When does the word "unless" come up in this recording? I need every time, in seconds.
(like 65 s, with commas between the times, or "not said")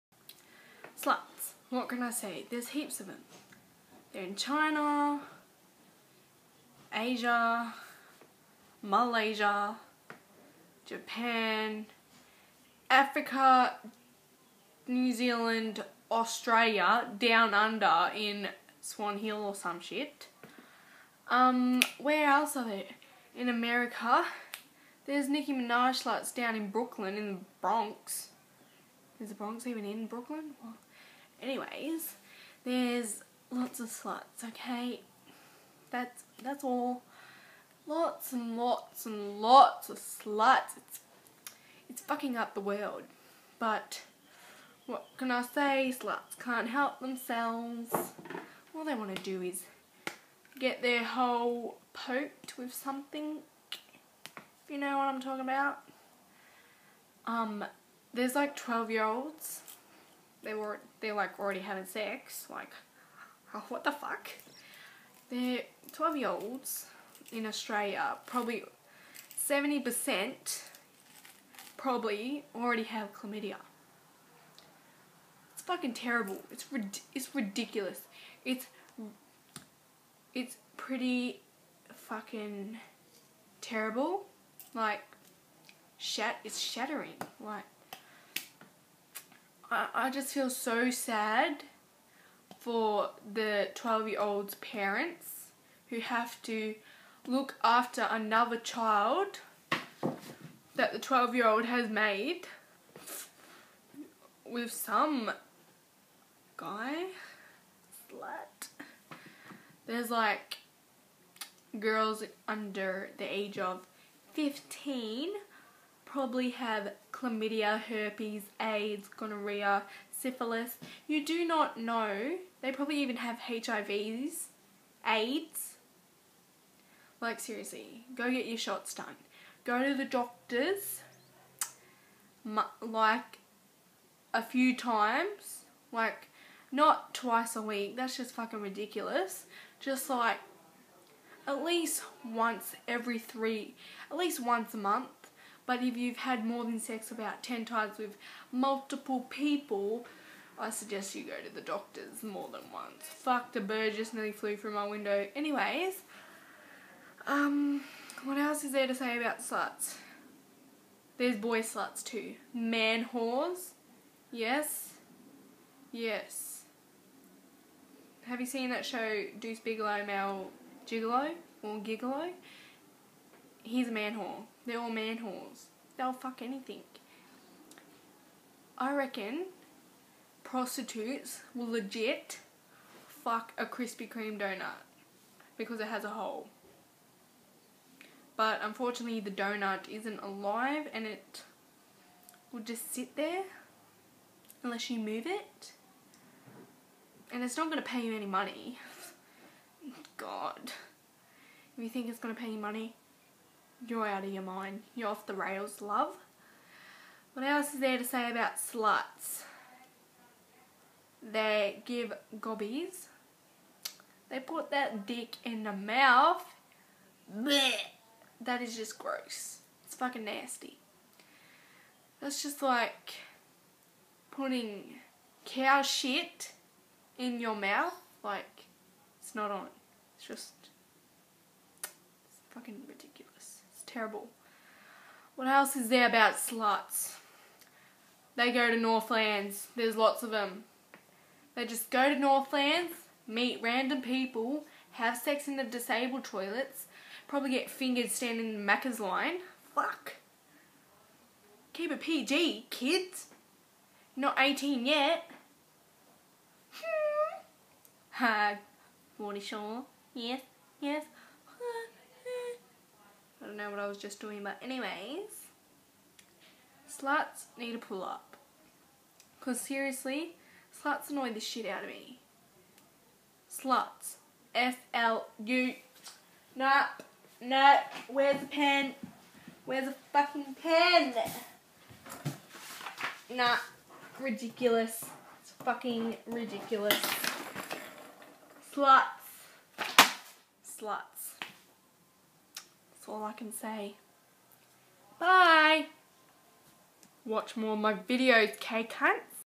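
194 s.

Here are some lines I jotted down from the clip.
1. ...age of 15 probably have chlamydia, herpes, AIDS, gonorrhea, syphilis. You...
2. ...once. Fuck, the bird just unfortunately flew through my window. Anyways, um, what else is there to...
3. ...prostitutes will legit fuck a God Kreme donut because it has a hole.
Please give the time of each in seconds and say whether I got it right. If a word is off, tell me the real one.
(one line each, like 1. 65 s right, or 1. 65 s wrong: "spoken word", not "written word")
1. 113 s right
2. 152 s wrong: "nearly", not "unfortunately"
3. 180 s wrong: "Krispy", not "God".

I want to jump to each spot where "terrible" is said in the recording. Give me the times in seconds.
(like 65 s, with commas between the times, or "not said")
75 s, 83 s, 233 s.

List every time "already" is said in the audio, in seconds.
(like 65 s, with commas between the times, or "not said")
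61 s, 72 s.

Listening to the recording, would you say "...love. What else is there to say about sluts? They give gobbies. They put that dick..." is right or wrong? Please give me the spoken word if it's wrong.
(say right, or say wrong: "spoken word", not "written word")
right.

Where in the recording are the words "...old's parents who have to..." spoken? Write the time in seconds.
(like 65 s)
94 s.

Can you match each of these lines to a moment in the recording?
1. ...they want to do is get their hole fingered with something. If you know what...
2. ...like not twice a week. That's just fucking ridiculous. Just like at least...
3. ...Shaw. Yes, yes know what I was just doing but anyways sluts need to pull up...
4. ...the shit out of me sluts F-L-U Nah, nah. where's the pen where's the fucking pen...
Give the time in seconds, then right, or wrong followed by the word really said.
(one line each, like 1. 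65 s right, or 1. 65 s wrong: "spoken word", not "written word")
1. 48 s wrong: "poked", not "fingered"
2. 135 s right
3. 259 s right
4. 271 s right.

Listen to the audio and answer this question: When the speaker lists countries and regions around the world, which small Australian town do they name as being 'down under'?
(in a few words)
Swan Hill.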